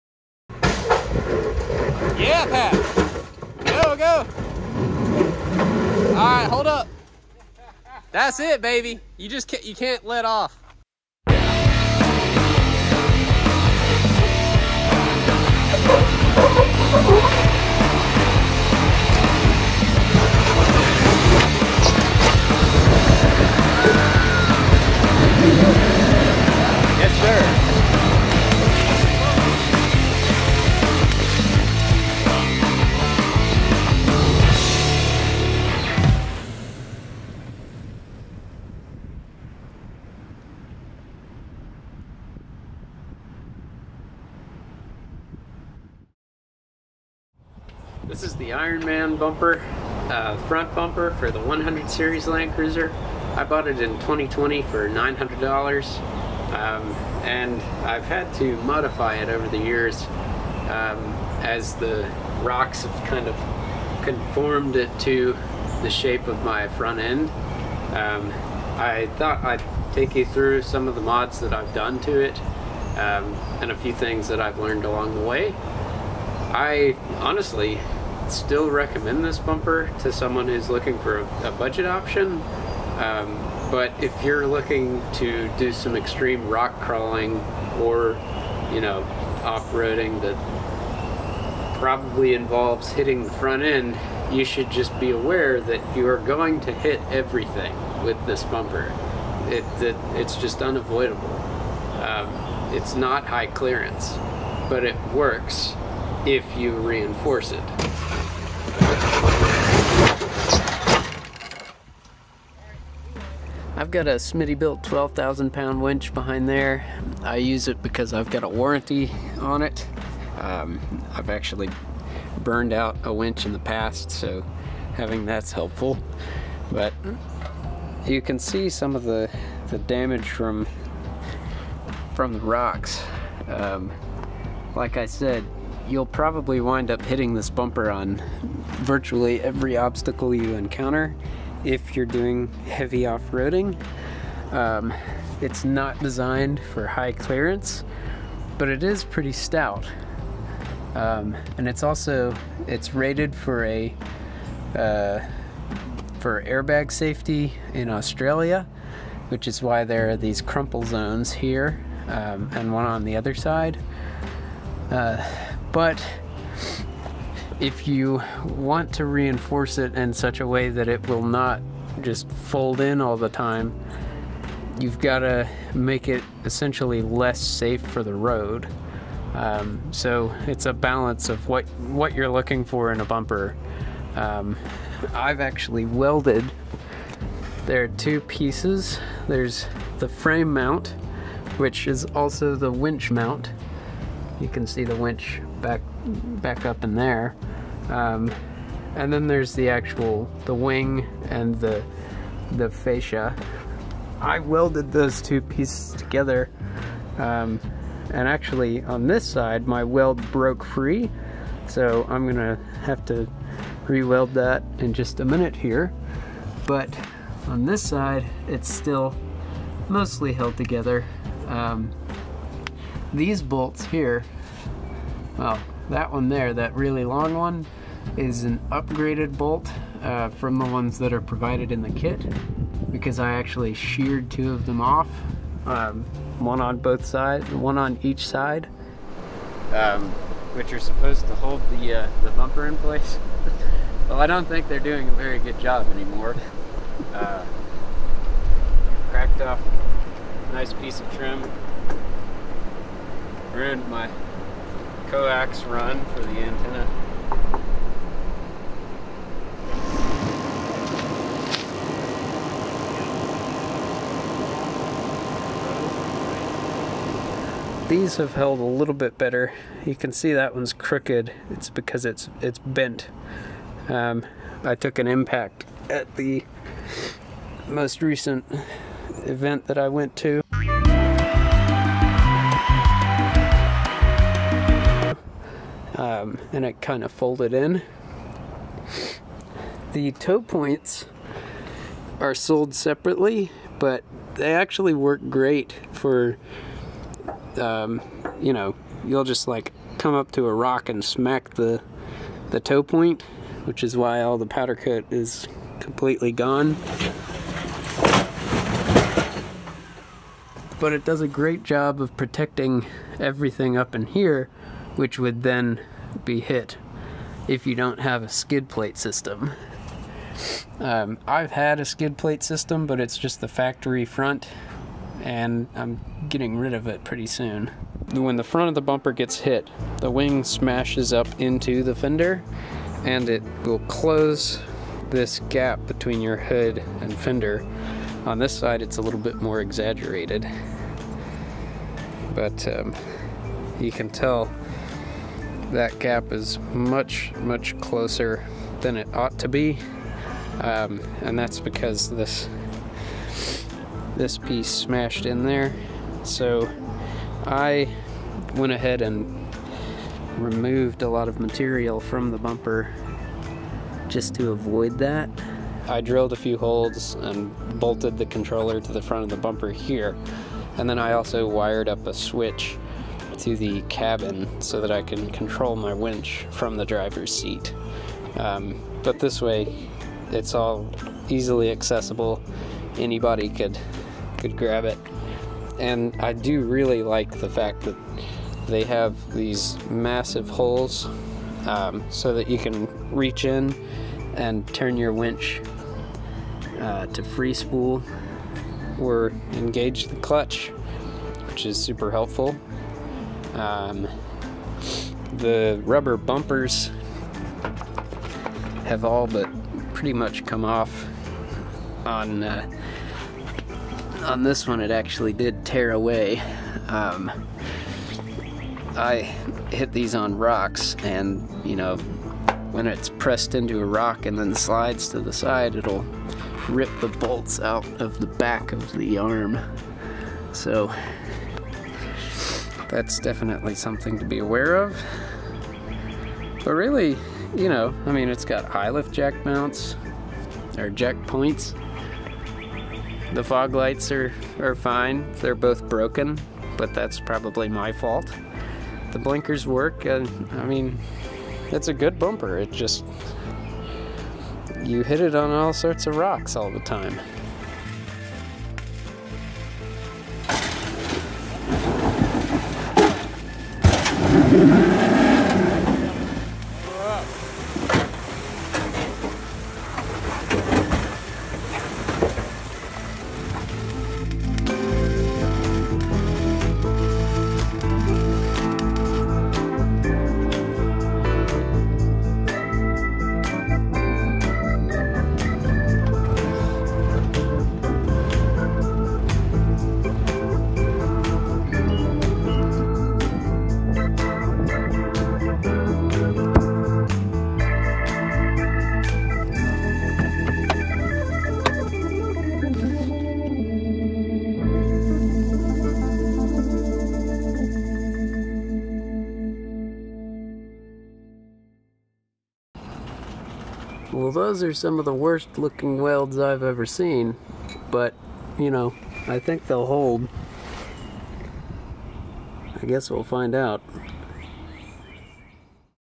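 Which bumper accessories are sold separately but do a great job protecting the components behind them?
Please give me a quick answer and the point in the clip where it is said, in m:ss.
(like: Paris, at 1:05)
toe points, at 4:50.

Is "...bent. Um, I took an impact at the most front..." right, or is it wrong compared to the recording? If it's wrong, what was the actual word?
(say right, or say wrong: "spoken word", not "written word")
wrong: "recent", not "front".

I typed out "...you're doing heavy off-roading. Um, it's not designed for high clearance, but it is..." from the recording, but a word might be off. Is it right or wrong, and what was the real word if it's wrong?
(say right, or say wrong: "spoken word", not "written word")
right.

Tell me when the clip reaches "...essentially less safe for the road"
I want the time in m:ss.
2:56.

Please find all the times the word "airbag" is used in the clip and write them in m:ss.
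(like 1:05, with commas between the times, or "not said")
2:36.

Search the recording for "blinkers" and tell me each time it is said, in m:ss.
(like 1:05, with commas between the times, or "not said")
7:29.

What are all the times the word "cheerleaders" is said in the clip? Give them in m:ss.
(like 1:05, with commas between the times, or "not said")
not said.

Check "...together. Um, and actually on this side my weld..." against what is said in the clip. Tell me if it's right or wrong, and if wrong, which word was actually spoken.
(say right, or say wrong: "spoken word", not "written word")
right.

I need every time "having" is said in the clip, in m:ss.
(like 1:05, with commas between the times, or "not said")
2:04.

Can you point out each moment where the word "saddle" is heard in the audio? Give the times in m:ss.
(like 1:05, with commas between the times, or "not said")
not said.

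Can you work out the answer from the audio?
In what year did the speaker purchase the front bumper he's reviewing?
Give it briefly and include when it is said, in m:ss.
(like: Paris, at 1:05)
2020, at 0:54.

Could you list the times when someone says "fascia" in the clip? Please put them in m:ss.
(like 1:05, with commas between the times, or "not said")
3:22.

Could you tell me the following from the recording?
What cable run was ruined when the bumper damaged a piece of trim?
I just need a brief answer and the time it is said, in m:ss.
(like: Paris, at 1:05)
coax run for the antenna, at 4:15.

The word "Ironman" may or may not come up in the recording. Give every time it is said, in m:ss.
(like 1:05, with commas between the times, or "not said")
0:48.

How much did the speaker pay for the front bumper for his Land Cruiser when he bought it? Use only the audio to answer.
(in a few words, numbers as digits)
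$900.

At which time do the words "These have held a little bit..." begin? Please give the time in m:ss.
4:27.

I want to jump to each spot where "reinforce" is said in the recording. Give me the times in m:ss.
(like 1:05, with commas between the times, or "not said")
1:46, 2:49.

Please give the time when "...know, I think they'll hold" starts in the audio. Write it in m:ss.
8:38.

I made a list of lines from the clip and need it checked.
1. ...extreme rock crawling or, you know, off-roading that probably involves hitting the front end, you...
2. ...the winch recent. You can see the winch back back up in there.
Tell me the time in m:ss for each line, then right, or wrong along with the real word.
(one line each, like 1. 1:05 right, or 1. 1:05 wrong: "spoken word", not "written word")
1. 1:25 right
2. 3:12 wrong: "mount", not "recent".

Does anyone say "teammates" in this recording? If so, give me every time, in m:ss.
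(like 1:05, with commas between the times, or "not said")
not said.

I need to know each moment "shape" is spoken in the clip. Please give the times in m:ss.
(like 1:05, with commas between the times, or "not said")
1:05.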